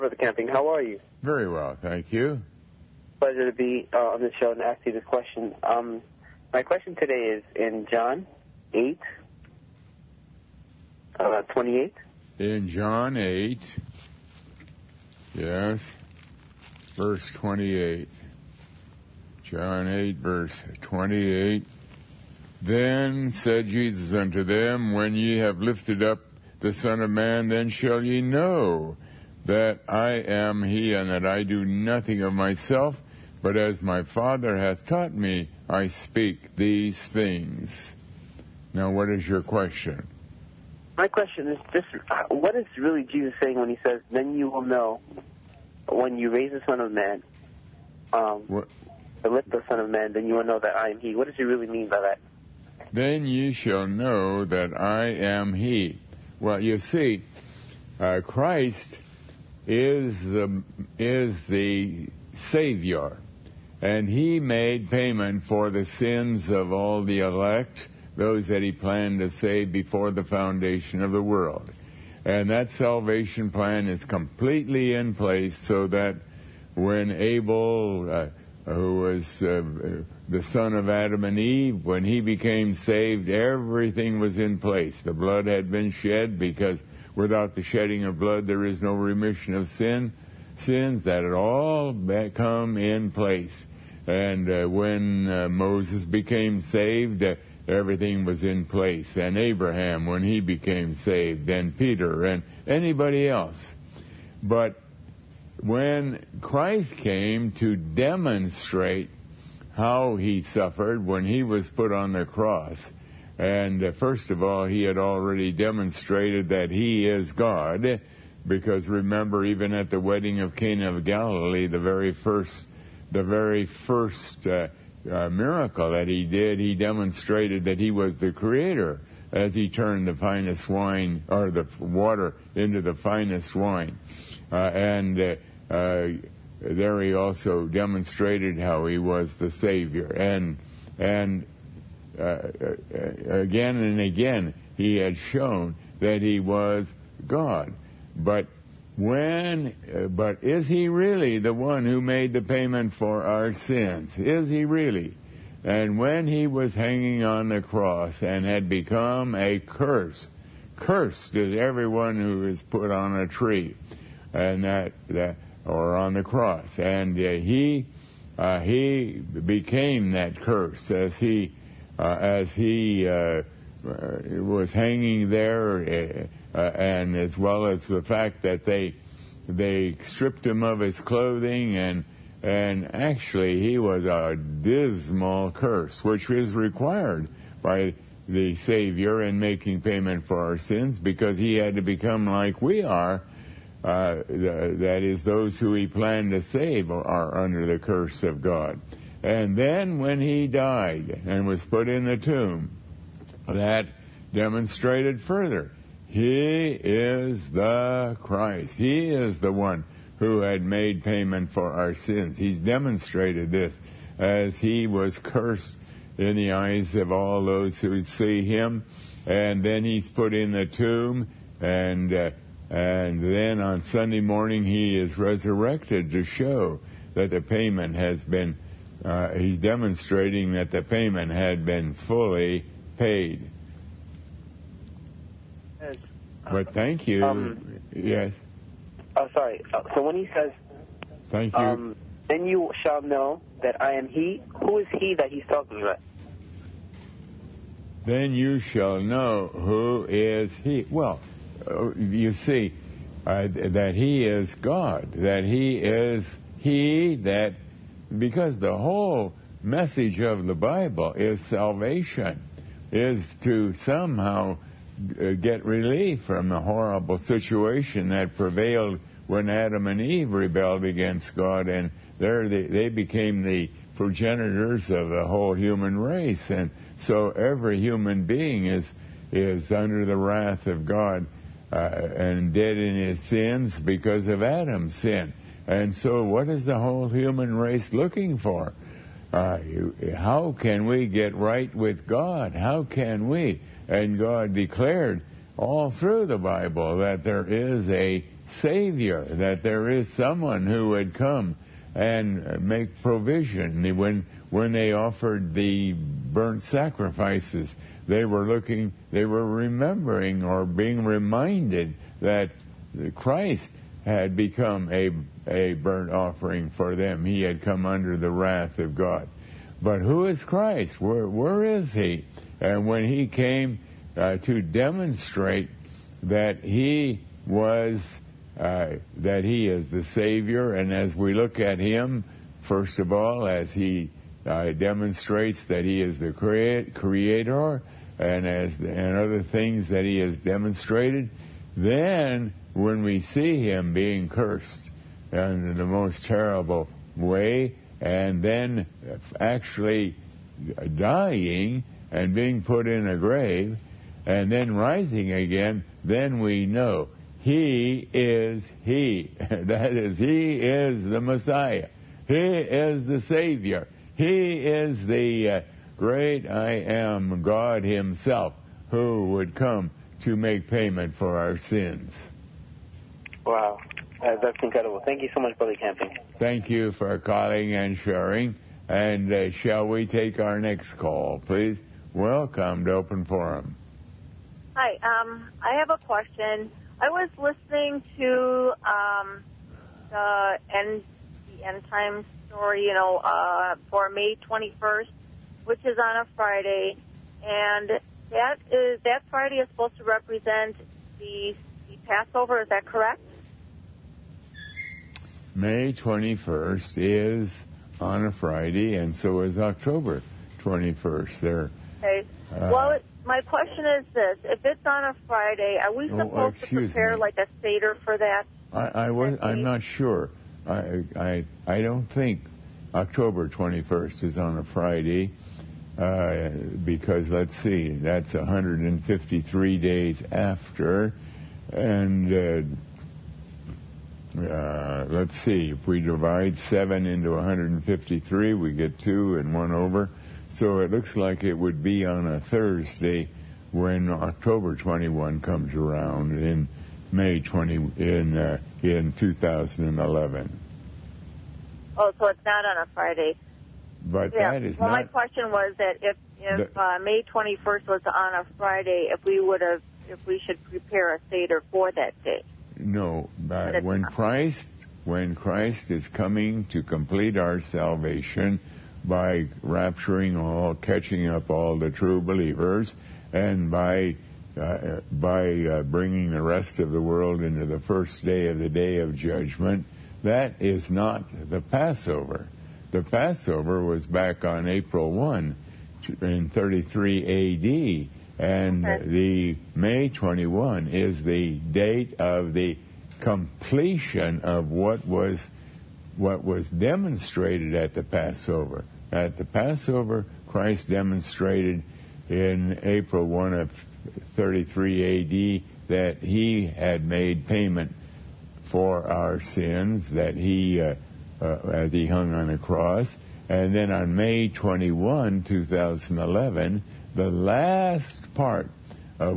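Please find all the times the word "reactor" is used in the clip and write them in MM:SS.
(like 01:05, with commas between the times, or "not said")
not said.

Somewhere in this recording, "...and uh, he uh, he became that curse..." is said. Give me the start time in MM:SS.
02:46.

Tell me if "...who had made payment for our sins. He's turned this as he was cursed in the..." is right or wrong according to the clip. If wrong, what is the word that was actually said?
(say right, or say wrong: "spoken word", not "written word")
wrong: "demonstrated", not "turned".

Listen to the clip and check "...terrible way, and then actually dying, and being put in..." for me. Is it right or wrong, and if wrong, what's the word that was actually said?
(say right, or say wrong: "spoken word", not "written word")
right.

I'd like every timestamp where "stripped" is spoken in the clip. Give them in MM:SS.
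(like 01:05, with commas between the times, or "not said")
03:00.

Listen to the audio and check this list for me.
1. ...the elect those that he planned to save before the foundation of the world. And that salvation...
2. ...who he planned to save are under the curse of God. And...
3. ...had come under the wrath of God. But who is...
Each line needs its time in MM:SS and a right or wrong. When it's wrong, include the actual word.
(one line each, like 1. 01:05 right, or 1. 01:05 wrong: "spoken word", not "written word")
1. 01:07 right
2. 03:15 right
3. 05:17 right.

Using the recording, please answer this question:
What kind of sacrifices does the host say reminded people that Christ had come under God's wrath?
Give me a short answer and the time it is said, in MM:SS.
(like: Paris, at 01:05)
Burnt sacrifices, at 05:05.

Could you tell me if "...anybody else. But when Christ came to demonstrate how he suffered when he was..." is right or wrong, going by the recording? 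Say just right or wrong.
right.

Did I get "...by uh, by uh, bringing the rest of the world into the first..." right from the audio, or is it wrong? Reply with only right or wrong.
right.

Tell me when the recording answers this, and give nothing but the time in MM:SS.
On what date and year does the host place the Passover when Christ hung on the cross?
08:04.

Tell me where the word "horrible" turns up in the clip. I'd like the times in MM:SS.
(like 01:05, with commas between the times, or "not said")
04:26.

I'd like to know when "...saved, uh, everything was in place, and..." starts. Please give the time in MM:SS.
01:36.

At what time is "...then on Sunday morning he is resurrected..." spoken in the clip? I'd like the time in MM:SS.
03:43.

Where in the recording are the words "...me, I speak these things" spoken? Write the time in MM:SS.
00:35.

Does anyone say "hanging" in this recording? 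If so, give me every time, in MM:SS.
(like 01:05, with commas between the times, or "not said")
02:36, 02:54.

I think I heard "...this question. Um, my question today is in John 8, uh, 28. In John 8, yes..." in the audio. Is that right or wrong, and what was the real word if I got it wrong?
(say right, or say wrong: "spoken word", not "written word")
right.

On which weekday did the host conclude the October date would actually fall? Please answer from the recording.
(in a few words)
Thursday.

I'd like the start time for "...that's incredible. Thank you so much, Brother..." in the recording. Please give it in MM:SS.
06:14.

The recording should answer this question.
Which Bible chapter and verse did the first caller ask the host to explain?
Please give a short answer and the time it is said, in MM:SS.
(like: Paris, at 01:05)
John 8:28, at 00:19.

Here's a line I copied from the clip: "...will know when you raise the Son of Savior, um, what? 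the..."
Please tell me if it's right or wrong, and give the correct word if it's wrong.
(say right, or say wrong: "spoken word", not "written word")
wrong: "Man", not "Savior".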